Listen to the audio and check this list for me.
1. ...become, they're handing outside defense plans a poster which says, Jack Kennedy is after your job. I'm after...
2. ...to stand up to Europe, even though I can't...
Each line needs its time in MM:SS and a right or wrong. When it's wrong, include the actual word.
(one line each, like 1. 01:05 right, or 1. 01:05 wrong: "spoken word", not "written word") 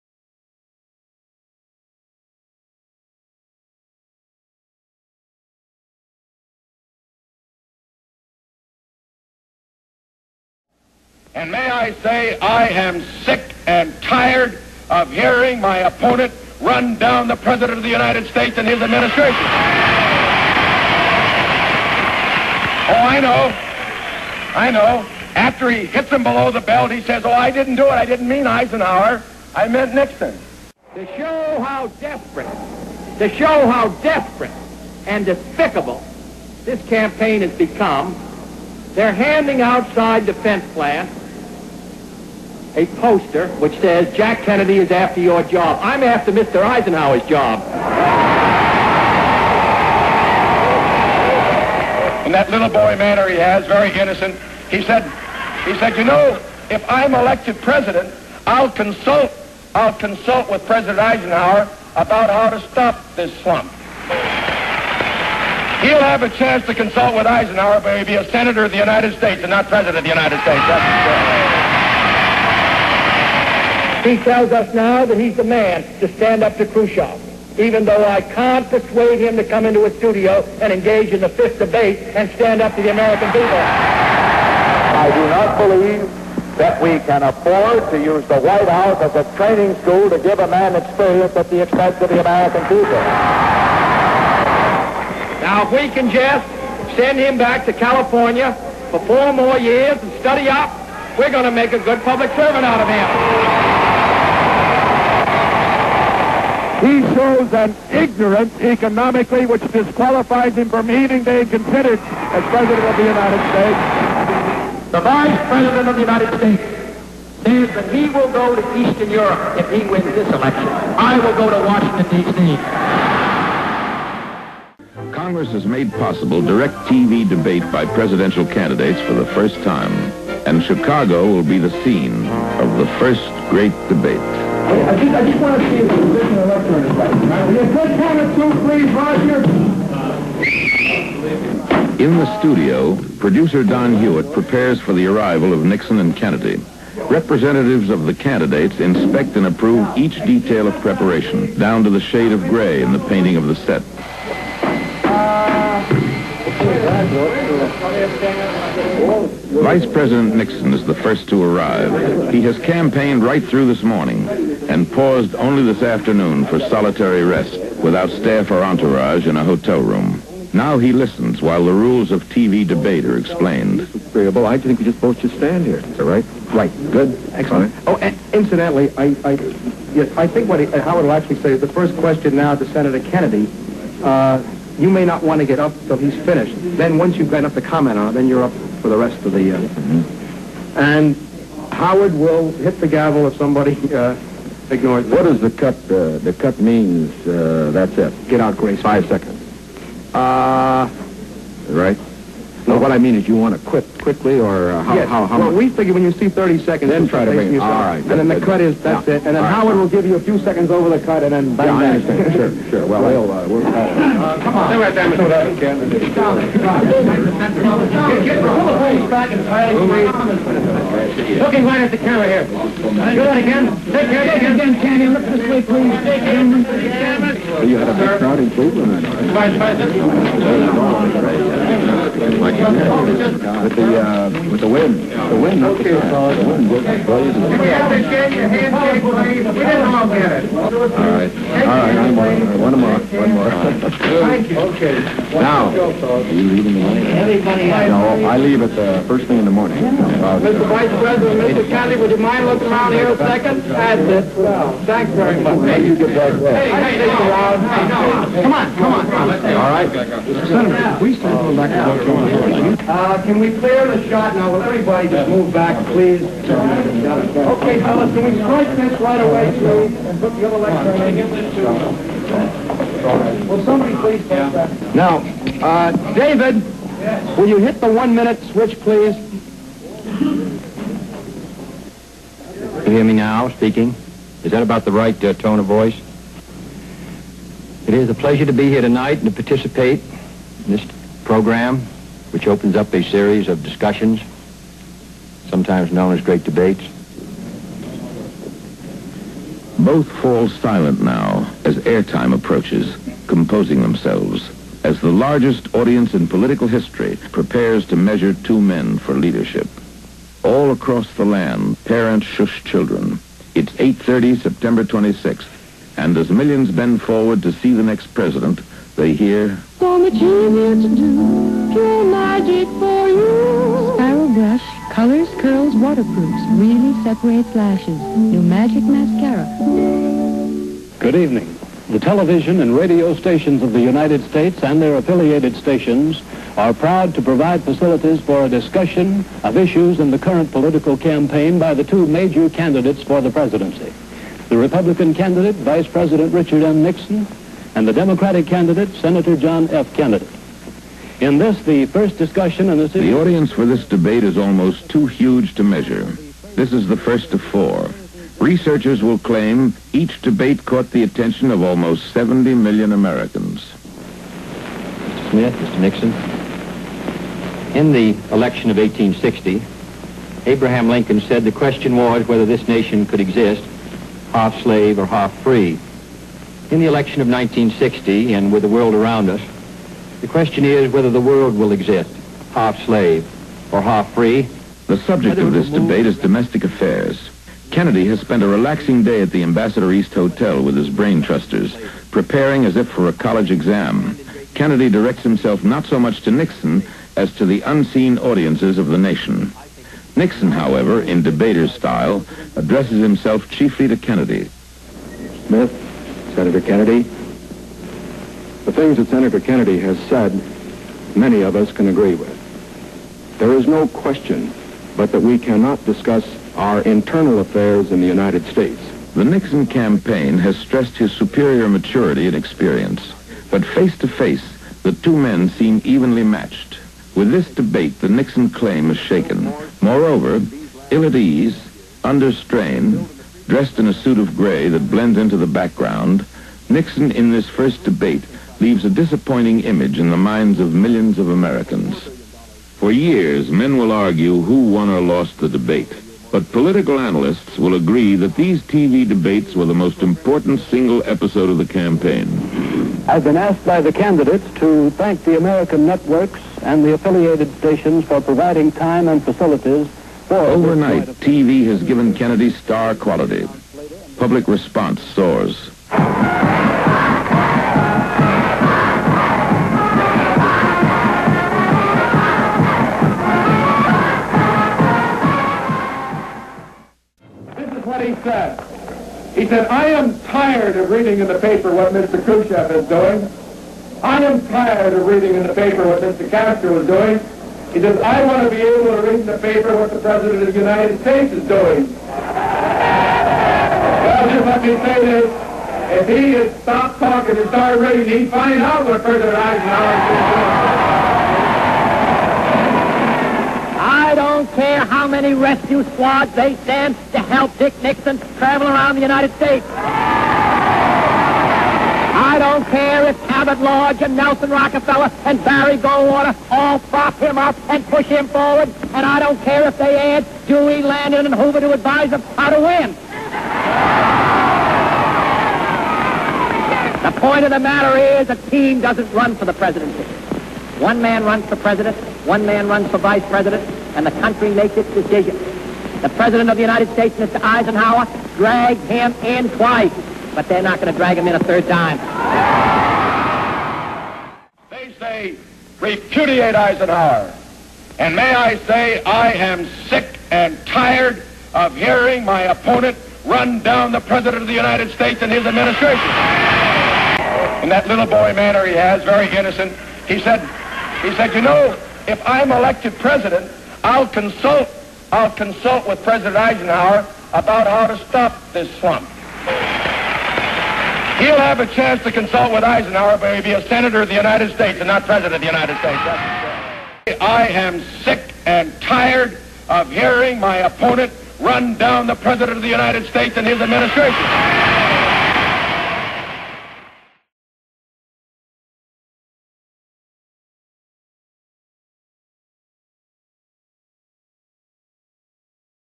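1. 00:37 right
2. 01:15 wrong: "Khrushchev", not "Europe".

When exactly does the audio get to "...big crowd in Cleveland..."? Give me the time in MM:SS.
03:47.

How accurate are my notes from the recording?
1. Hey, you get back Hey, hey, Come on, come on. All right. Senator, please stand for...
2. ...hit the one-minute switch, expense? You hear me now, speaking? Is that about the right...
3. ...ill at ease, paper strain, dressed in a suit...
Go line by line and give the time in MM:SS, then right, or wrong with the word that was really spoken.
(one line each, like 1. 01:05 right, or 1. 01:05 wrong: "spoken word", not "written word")
1. 04:15 right
2. 04:37 wrong: "please", not "expense"
3. 07:10 wrong: "under", not "paper".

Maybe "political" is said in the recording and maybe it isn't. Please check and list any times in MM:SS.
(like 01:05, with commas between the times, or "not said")
05:06, 05:40, 07:26.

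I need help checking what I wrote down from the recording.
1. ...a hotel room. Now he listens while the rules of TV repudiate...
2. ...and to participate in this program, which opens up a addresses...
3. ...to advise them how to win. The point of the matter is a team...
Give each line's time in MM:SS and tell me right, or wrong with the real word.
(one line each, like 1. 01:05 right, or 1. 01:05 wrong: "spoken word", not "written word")
1. 02:49 wrong: "debate", not "repudiate"
2. 04:49 wrong: "series", not "addresses"
3. 08:41 right.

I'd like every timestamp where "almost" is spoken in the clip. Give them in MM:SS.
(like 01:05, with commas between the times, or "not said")
05:54, 06:01.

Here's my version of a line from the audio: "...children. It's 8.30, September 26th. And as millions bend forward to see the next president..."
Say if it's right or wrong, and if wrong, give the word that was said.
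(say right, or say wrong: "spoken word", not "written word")
right.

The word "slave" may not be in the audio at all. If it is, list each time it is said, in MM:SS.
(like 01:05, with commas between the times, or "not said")
06:14, 06:22.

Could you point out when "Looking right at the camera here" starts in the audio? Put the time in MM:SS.
03:41.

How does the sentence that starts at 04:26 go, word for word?
Okay, fellas, can we strike this right away, please, and put the other lecture in?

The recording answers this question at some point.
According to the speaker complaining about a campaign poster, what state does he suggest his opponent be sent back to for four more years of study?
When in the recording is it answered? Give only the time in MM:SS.
01:37.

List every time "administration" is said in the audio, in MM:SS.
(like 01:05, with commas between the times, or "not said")
00:18, 09:15, 09:43.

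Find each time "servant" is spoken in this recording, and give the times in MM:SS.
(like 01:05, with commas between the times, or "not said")
01:42.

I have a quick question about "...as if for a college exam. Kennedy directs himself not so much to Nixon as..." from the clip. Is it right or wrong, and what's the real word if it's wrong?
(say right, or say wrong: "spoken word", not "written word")
right.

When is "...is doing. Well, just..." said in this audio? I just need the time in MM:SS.
08:11.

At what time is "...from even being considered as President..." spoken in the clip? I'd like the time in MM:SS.
01:50.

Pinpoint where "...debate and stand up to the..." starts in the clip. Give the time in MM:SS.
01:21.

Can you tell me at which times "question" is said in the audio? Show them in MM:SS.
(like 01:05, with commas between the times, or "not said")
03:01, 06:11, 06:20, 06:53.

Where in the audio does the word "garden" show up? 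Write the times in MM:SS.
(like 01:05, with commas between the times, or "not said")
not said.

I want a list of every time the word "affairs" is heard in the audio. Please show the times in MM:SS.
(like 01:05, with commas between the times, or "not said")
06:26, 06:57.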